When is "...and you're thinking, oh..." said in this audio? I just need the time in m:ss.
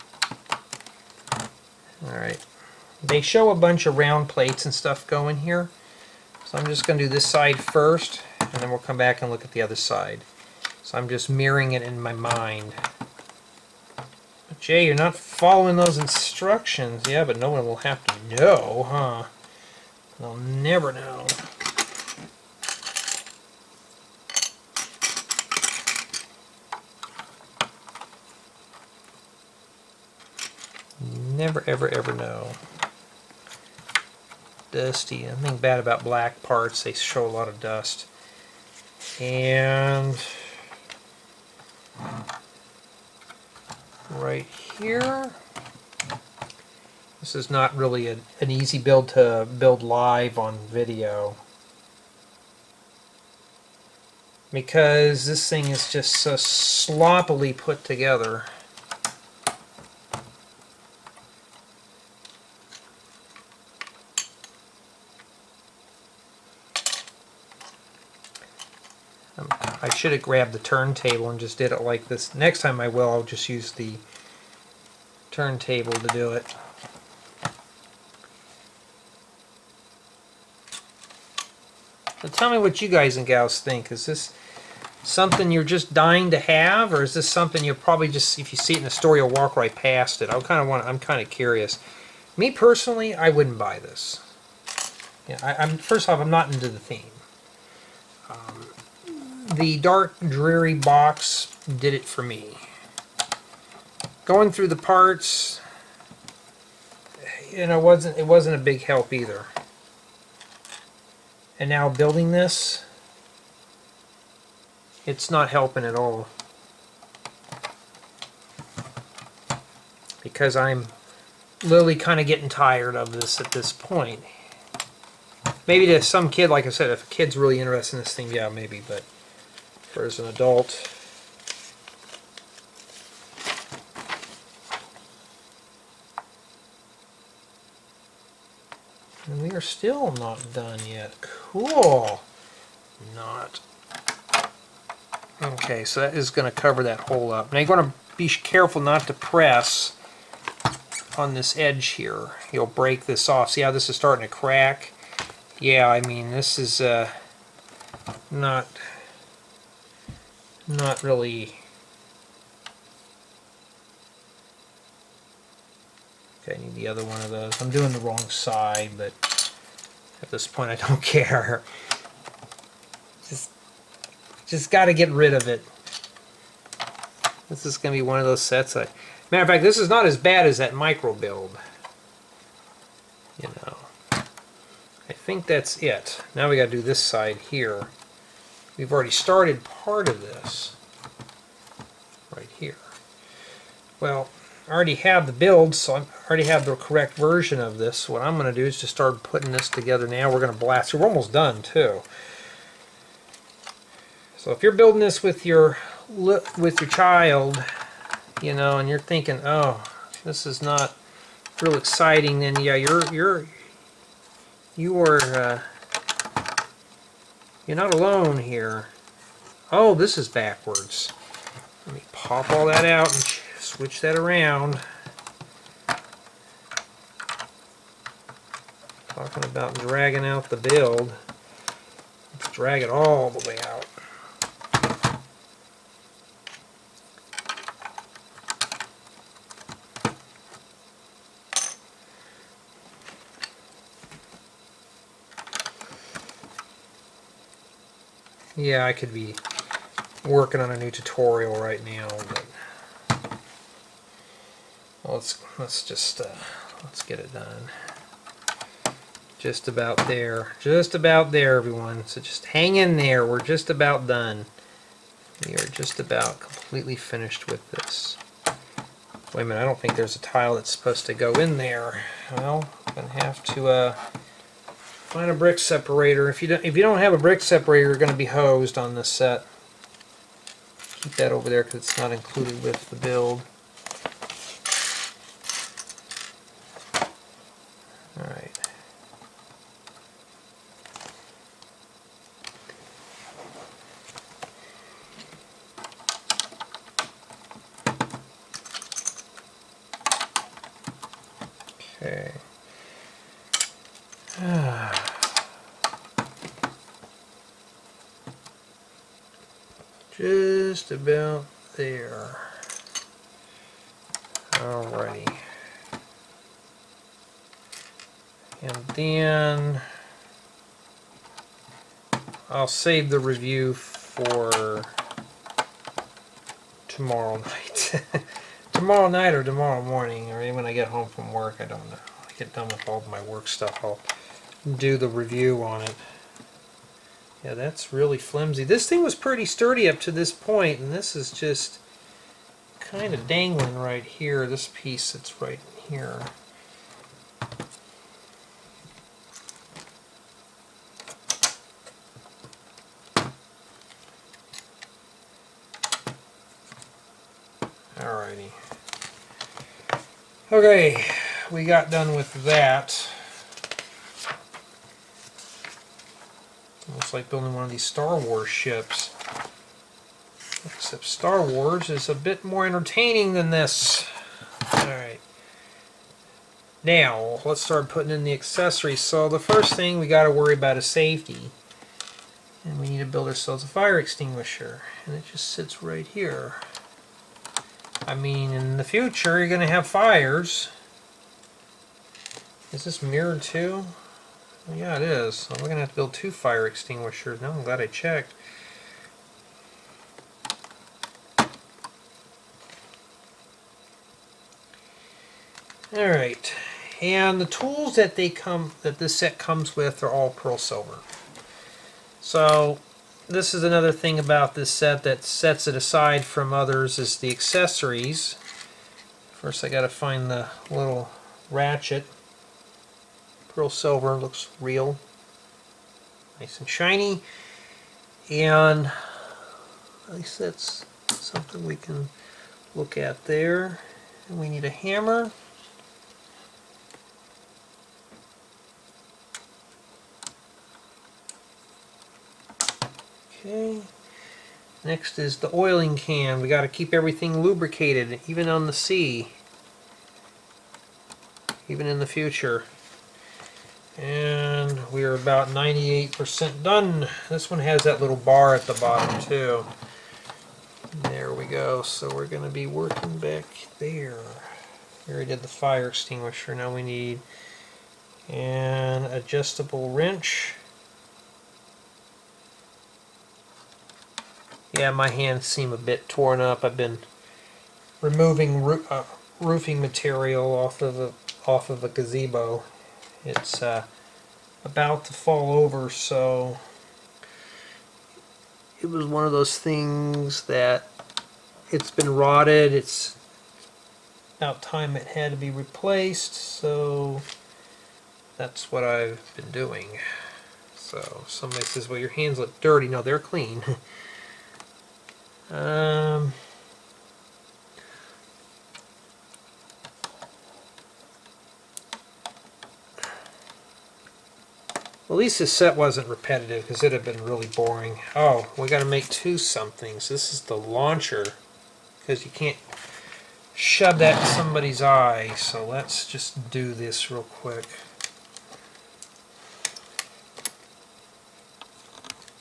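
3:28.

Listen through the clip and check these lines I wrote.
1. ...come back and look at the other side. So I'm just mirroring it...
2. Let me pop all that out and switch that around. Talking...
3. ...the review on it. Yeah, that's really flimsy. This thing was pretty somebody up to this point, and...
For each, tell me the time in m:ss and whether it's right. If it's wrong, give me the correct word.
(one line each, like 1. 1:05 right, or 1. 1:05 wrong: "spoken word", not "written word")
1. 0:08 right
2. 3:41 right
3. 5:34 wrong: "sturdy", not "somebody".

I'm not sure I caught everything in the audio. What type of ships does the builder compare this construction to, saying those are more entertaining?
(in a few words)
Star Wars ships.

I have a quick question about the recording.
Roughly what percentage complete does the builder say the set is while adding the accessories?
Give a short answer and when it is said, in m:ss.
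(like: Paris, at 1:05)
98%, at 7:35.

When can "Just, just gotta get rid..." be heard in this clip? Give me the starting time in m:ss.
2:53.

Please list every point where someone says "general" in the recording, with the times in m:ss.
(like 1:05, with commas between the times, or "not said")
not said.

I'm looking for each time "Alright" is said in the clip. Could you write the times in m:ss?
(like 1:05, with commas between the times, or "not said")
0:02, 6:14, 6:45.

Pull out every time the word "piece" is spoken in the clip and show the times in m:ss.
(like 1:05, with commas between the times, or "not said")
5:44.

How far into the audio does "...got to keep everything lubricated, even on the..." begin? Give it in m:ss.
7:26.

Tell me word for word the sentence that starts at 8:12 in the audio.
It's about time it had to be replaced, so that's what I've been doing.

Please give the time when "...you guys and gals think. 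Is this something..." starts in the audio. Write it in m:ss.
1:22.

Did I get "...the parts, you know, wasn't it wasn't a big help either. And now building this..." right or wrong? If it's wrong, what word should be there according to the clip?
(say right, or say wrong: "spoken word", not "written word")
right.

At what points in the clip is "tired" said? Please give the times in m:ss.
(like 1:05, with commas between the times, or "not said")
2:02.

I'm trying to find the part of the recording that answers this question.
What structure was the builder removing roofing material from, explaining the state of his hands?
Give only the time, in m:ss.
8:01.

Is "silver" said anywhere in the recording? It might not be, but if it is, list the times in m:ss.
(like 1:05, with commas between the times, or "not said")
6:50, 7:03.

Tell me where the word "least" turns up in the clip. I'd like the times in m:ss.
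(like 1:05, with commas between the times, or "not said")
7:10, 8:35.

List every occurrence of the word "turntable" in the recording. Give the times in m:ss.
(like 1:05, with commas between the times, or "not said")
1:10, 1:15.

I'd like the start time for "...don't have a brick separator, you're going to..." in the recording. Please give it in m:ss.
4:36.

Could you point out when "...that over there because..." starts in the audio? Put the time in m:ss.
4:41.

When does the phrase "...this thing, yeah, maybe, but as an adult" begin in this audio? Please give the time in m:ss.
2:08.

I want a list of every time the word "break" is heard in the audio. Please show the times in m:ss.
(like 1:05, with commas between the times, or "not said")
2:32.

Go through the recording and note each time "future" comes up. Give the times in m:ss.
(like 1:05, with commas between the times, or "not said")
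6:28, 7:32.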